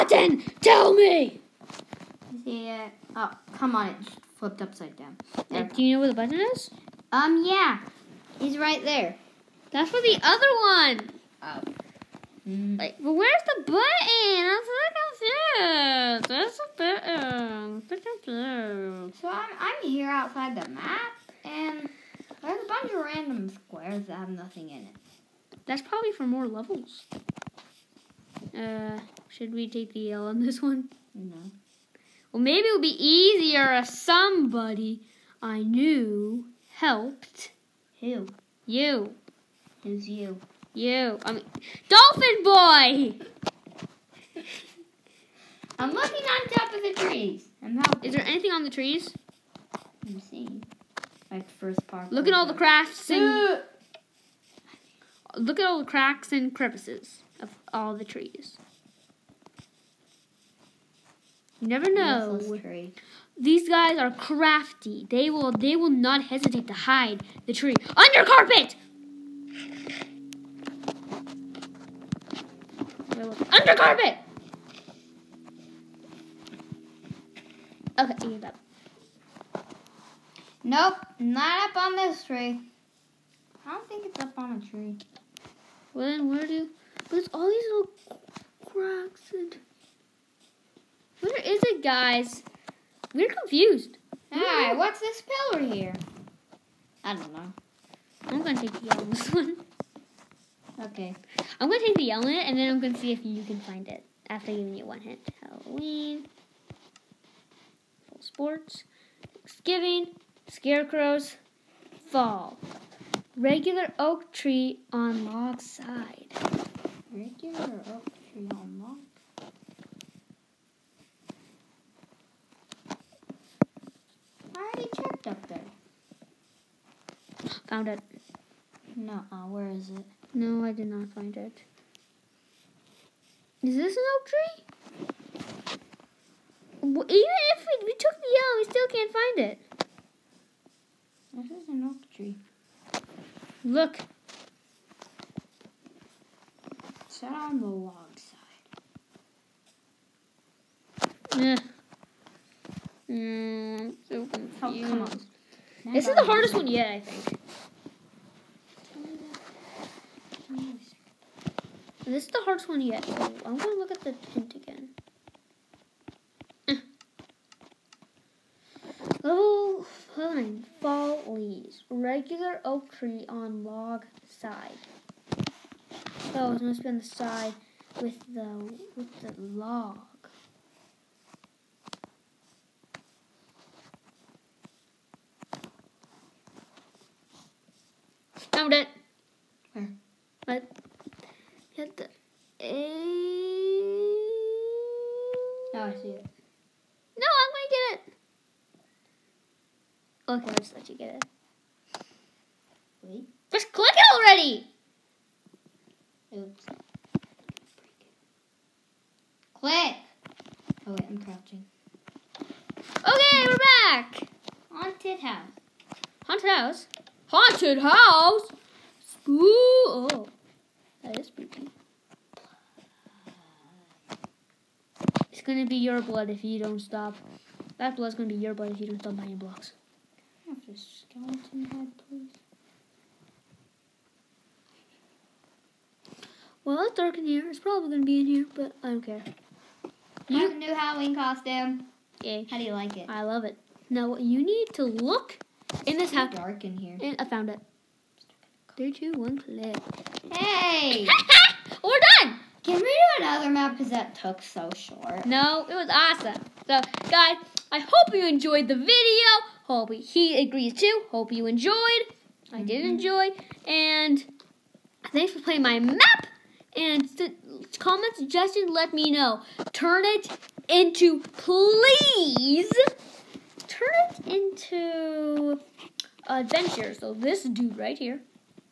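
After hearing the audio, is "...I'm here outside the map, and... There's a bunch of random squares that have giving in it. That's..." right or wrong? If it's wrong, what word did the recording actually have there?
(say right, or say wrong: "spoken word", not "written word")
wrong: "nothing", not "giving".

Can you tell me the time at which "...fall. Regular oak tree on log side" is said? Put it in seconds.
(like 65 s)
112 s.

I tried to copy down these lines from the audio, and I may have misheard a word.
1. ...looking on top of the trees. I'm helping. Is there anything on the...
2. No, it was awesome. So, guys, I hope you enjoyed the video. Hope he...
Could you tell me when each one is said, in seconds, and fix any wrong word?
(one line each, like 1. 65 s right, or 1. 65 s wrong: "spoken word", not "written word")
1. 45 s right
2. 255 s right.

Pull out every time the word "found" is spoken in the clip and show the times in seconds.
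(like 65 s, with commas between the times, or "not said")
127 s, 188 s, 247 s.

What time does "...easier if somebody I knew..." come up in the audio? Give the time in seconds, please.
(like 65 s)
33 s.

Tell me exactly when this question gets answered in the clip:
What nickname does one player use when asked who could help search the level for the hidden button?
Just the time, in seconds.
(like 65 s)
41 s.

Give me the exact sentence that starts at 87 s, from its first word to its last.
But it's all these little cracks and...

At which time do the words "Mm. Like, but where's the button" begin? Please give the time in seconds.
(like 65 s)
12 s.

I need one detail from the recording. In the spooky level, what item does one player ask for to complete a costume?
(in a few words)
Skeleton head.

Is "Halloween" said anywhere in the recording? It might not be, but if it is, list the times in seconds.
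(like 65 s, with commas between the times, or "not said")
105 s, 240 s.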